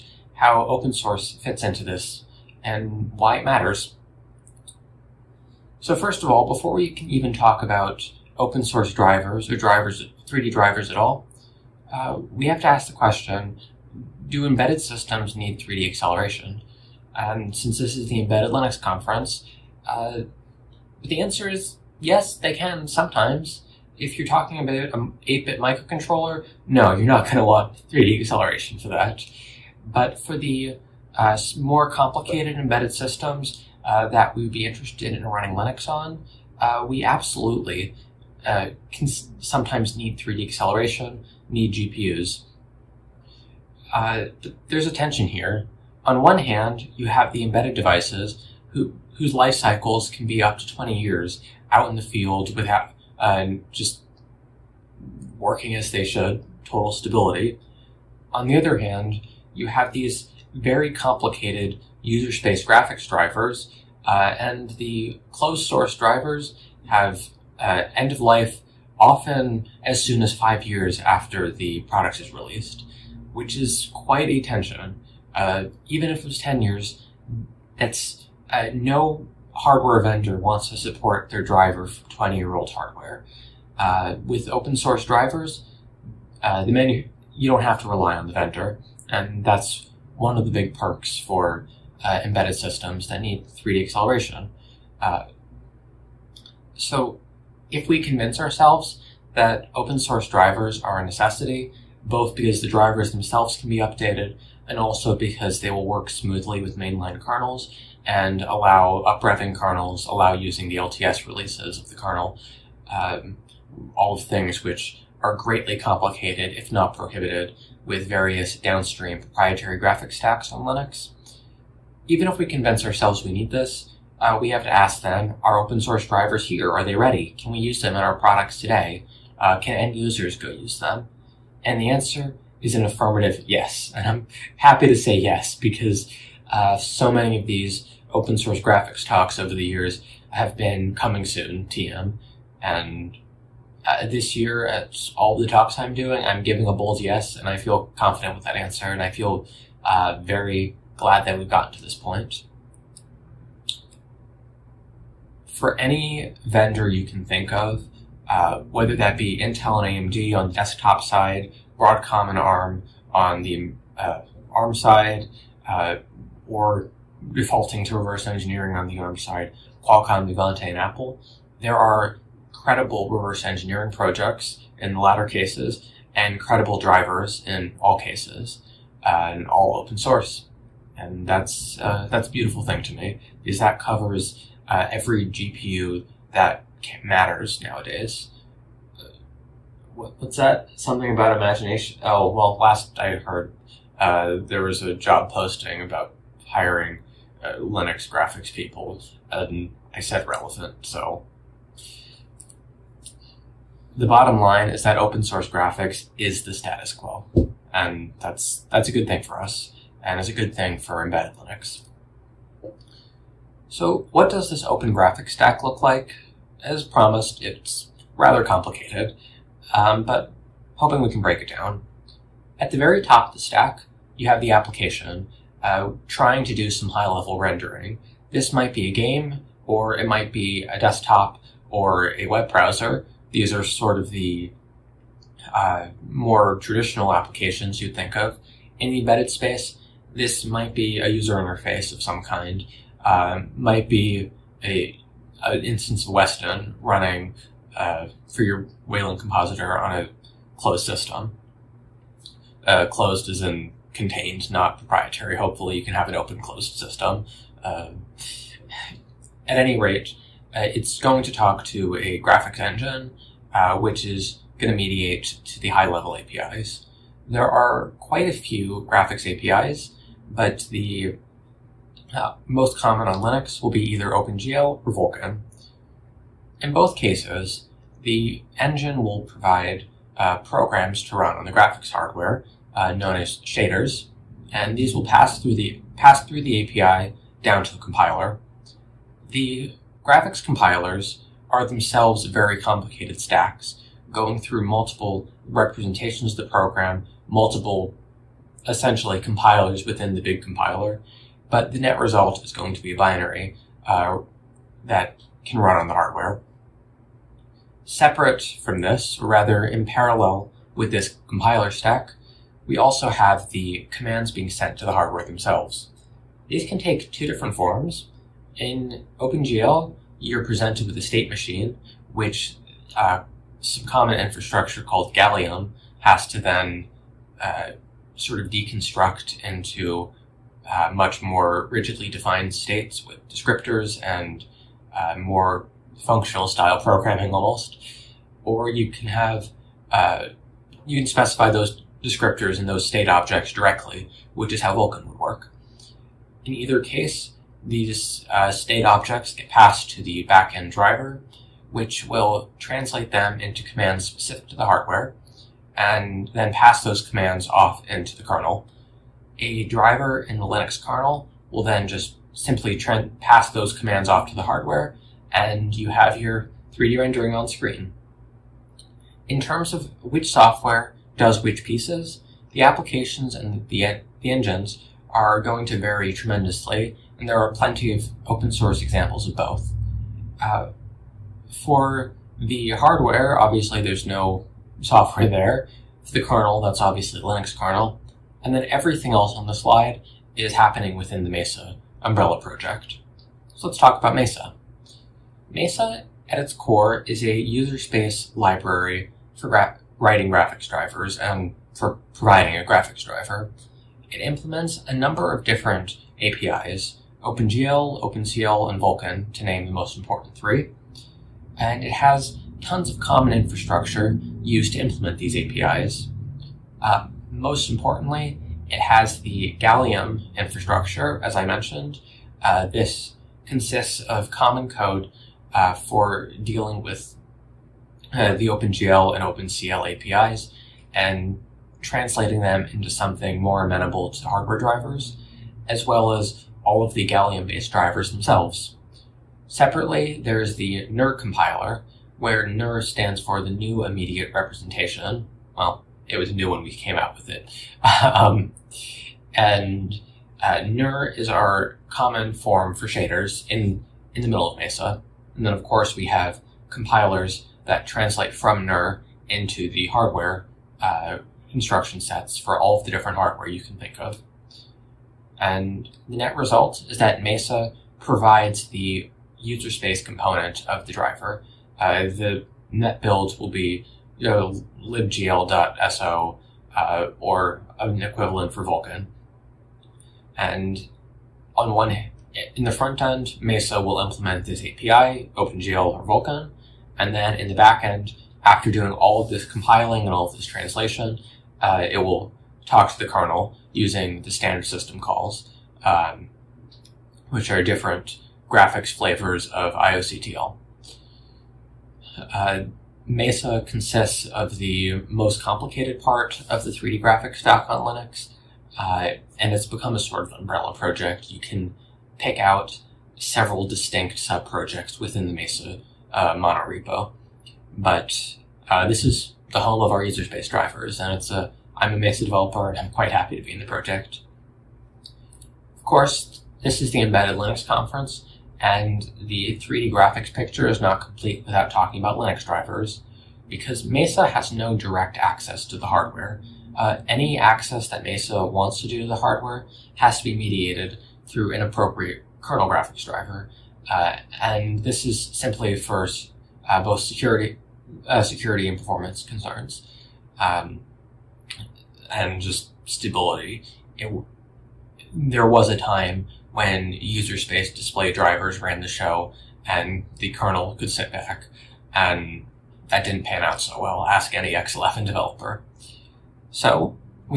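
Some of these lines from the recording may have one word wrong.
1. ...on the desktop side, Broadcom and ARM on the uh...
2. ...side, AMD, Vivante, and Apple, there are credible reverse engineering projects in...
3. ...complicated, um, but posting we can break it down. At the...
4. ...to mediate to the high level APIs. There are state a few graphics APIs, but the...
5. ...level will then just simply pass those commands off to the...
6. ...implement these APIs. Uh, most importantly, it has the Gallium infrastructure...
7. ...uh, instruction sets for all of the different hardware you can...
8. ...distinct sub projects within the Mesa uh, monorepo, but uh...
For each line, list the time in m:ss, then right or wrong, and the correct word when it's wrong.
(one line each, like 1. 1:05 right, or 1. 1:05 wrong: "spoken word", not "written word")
1. 2:40 right
2. 2:49 wrong: "Qualcomm", not "AMD"
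3. 3:38 wrong: "hoping", not "posting"
4. 4:24 wrong: "quite", not "state"
5. 6:00 wrong: "kernel", not "level"
6. 6:54 right
7. 7:40 right
8. 8:33 right.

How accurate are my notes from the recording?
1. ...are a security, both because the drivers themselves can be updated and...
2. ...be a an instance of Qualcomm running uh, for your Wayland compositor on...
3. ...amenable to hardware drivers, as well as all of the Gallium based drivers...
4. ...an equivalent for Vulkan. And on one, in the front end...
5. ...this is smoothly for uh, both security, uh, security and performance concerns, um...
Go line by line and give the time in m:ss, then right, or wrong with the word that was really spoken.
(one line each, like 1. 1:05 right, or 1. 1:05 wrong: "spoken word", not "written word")
1. 1:40 wrong: "necessity", not "security"
2. 4:03 wrong: "Weston", not "Qualcomm"
3. 7:13 right
4. 7:57 right
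5. 9:04 wrong: "simply", not "smoothly".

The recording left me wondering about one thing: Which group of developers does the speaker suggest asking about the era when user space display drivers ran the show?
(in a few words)
X11 developers.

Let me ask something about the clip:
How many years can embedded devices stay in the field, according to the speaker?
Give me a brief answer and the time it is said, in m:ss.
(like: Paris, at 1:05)
20 years, at 0:50.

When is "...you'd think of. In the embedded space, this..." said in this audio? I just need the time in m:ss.
3:57.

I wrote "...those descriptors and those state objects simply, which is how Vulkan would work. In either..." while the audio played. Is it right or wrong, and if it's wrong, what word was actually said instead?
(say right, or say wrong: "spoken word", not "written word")
wrong: "directly", not "simply".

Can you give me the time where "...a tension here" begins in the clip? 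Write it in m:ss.
0:44.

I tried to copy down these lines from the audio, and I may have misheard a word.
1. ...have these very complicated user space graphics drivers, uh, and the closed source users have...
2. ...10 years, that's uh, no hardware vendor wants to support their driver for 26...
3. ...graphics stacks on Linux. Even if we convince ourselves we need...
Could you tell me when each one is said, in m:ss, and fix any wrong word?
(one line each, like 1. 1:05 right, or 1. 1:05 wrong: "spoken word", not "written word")
1. 0:59 wrong: "drivers", not "users"
2. 1:16 wrong: "20", not "26"
3. 1:59 right.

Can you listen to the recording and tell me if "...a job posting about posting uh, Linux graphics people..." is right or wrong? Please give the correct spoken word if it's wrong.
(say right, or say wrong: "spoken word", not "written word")
wrong: "hiring", not "posting".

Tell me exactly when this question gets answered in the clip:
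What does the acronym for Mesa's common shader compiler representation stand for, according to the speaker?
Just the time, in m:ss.
7:23.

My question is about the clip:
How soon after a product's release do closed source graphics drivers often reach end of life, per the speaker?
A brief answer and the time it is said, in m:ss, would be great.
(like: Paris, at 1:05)
5 years, at 1:10.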